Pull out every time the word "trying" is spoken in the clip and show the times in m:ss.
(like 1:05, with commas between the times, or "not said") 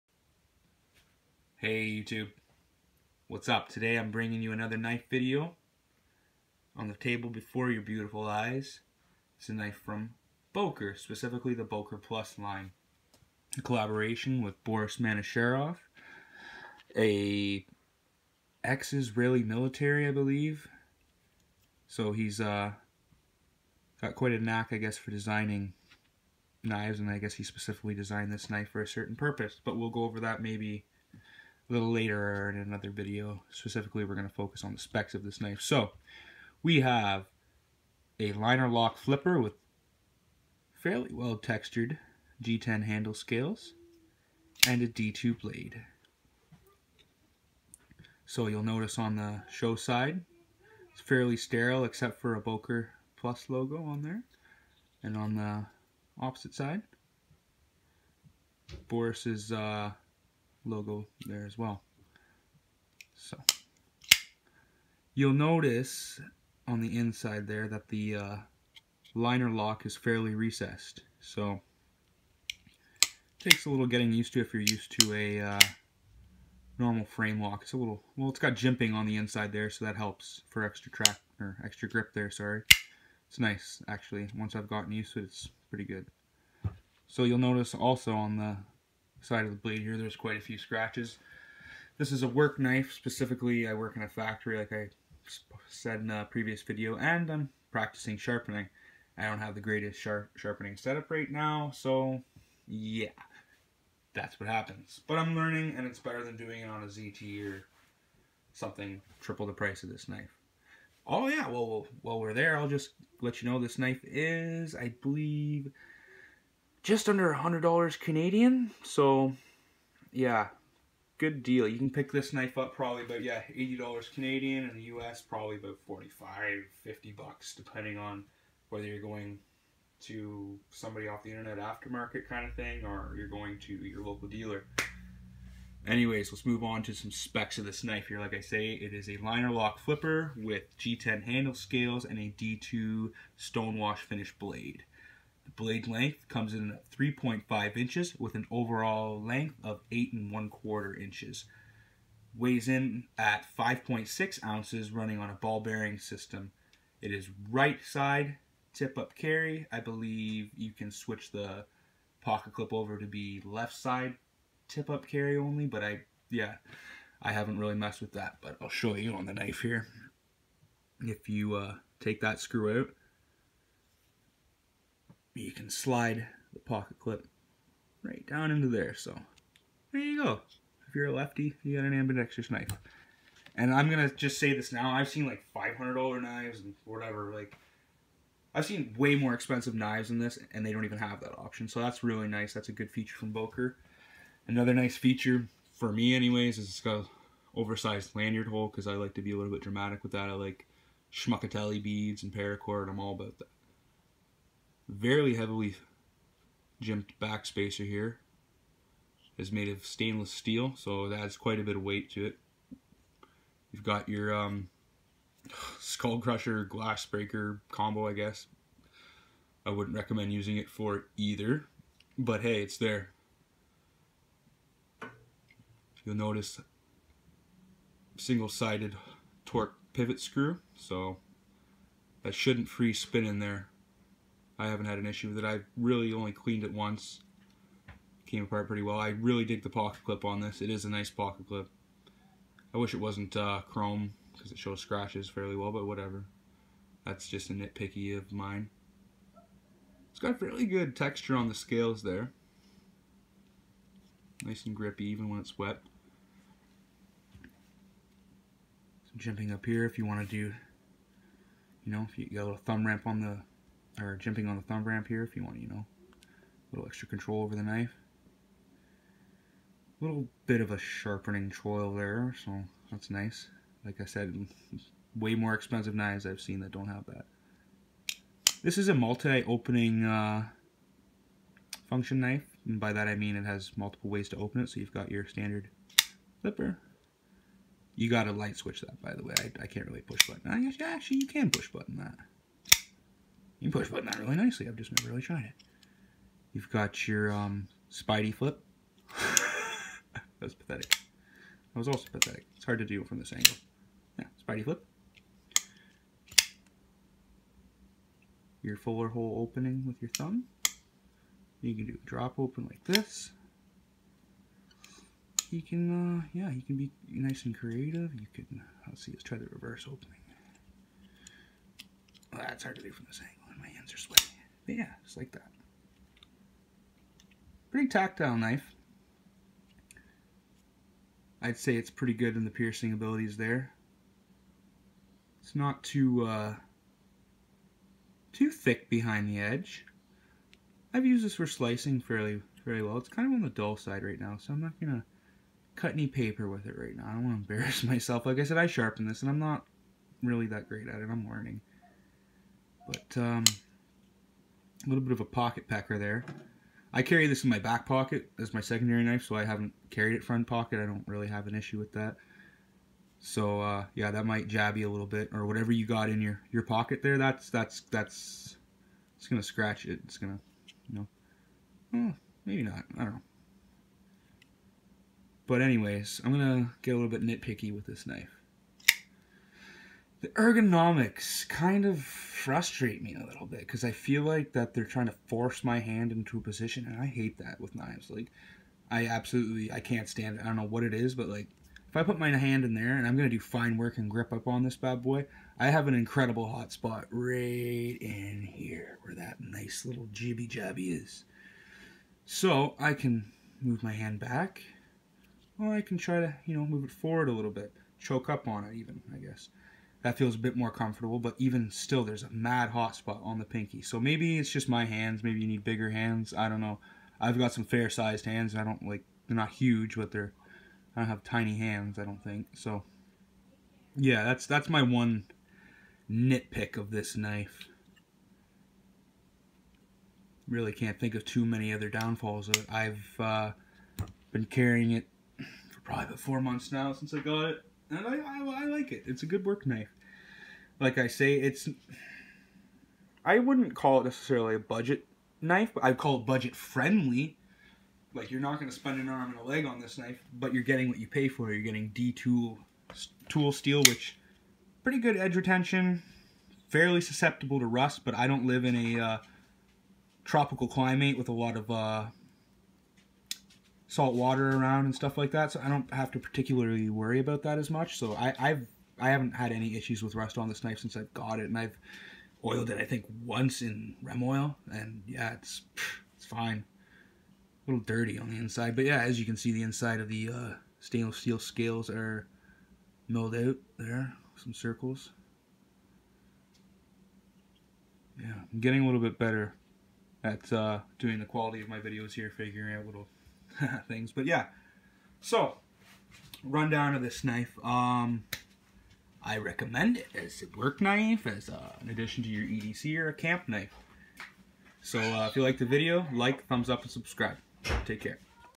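6:24.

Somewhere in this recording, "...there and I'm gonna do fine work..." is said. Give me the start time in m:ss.
6:32.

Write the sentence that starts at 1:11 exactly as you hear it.
So takes a little getting used to if you're used to a uh, normal frame lock.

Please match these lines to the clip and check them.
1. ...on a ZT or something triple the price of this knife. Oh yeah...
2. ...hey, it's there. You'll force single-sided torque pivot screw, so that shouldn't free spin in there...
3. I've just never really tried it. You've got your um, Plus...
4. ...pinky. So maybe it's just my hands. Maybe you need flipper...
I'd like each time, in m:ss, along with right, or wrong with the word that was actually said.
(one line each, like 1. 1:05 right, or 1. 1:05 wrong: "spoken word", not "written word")
1. 1:46 right
2. 3:42 wrong: "notice", not "force"
3. 4:54 wrong: "Spidey", not "Plus"
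4. 6:53 wrong: "bigger", not "flipper".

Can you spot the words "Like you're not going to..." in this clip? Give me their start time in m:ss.
7:28.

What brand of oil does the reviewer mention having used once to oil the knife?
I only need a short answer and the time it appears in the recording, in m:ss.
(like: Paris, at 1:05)
Rem oil, at 7:54.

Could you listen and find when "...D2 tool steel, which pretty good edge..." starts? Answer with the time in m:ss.
7:31.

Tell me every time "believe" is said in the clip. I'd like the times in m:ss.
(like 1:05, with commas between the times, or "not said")
0:20, 1:55, 2:39.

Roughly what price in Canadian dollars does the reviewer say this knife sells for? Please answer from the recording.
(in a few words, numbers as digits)
$80.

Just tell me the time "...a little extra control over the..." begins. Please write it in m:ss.
4:25.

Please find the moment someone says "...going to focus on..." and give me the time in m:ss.
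0:34.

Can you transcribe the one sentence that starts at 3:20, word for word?
I like schmuckatelli beads and paracord.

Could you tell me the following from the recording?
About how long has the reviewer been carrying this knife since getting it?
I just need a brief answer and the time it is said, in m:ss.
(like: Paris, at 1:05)
About 4 months, at 7:16.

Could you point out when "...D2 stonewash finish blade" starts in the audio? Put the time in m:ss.
2:22.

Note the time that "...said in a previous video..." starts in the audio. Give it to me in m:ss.
1:35.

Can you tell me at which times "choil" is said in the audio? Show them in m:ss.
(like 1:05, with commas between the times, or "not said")
4:31.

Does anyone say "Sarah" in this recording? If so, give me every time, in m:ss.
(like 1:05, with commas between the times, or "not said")
not said.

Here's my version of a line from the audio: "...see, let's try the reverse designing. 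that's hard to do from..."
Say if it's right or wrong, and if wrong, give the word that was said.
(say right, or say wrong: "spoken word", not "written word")
wrong: "opening", not "designing".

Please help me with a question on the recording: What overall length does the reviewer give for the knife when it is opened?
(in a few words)
8 1/4 inches.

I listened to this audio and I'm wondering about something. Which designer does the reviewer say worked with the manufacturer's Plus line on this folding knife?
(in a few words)
Boris Manasherov.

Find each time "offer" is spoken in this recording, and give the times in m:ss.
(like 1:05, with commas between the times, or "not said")
not said.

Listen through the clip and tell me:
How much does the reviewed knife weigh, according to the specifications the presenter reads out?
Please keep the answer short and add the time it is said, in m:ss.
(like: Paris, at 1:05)
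5.6 ounces, at 2:33.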